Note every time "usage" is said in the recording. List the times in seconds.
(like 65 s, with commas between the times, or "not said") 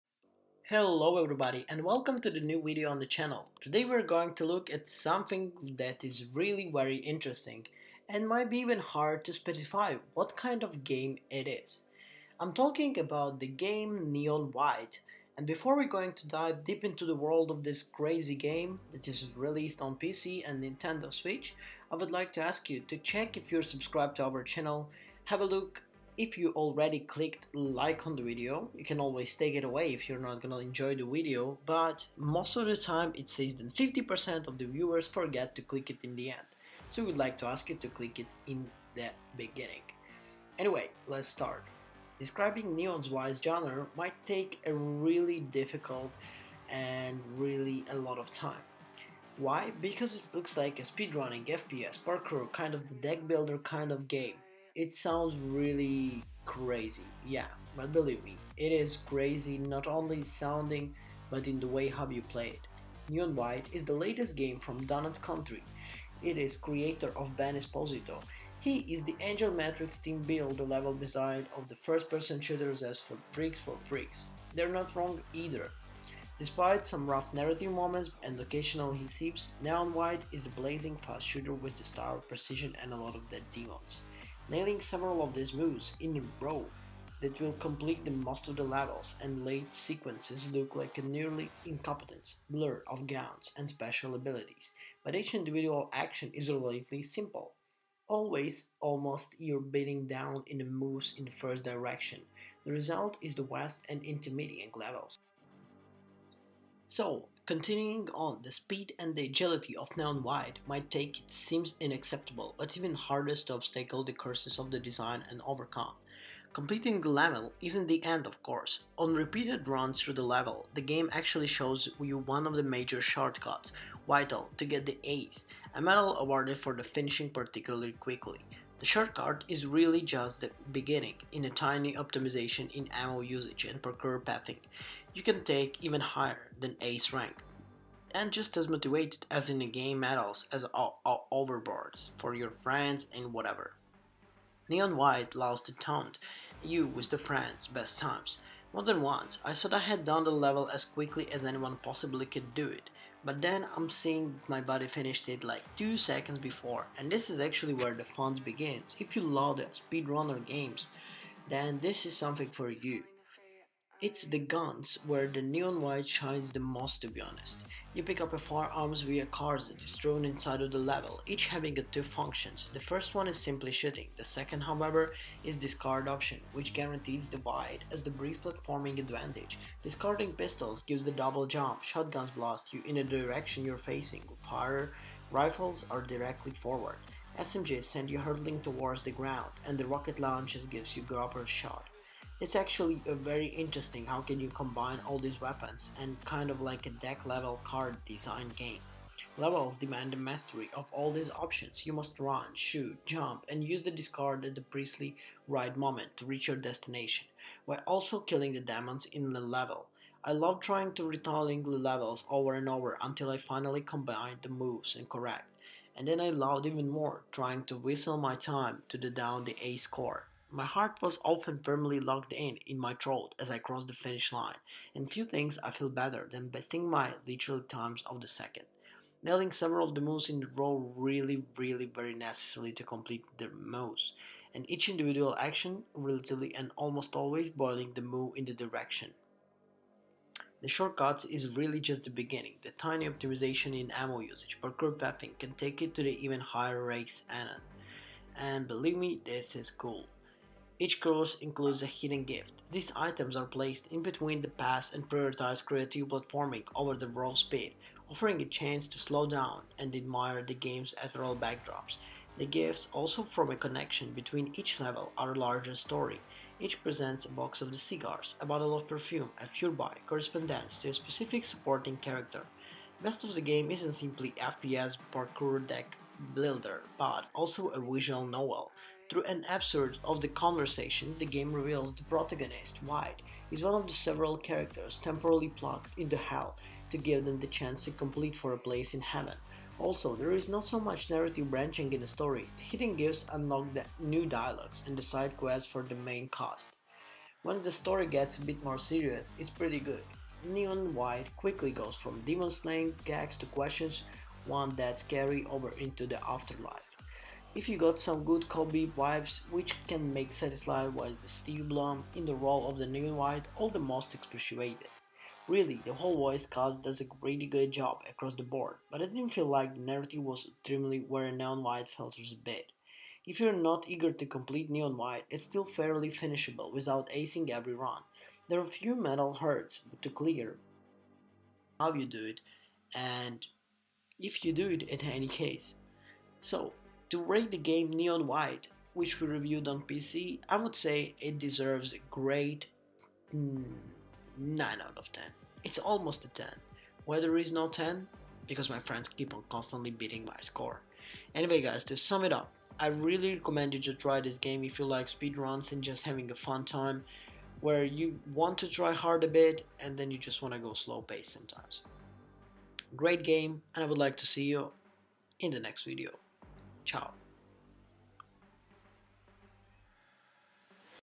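133 s, 244 s.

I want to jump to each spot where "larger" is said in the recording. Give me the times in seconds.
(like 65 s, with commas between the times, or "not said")
265 s.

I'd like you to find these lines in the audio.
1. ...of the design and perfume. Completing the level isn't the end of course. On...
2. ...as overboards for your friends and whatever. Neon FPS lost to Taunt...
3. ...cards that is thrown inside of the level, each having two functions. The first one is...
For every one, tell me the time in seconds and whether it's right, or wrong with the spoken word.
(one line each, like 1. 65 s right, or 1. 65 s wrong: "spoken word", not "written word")
1. 114 s wrong: "overcome", not "perfume"
2. 140 s wrong: "White", not "FPS"
3. 169 s right.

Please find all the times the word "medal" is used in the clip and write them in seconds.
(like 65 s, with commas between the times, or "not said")
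125 s, 139 s.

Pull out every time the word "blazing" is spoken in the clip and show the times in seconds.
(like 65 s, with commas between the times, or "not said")
80 s.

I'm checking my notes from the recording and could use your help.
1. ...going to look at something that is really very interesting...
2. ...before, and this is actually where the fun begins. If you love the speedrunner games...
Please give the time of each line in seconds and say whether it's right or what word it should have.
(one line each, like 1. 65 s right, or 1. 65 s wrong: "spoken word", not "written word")
1. 4 s right
2. 156 s right.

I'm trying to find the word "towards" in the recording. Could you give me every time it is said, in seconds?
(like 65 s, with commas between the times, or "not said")
188 s.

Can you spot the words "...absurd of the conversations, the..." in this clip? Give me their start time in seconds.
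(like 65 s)
279 s.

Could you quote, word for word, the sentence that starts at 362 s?
Great game and I would like to see you in the next video.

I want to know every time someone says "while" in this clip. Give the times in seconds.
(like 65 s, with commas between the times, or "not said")
207 s, 310 s.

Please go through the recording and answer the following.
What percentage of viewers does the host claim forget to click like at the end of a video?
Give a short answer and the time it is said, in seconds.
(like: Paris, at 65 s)
50%, at 33 s.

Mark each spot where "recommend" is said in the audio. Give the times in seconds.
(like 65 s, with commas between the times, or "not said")
353 s.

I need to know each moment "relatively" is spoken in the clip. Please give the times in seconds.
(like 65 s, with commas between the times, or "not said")
96 s, 235 s.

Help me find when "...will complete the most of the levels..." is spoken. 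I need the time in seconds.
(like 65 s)
87 s.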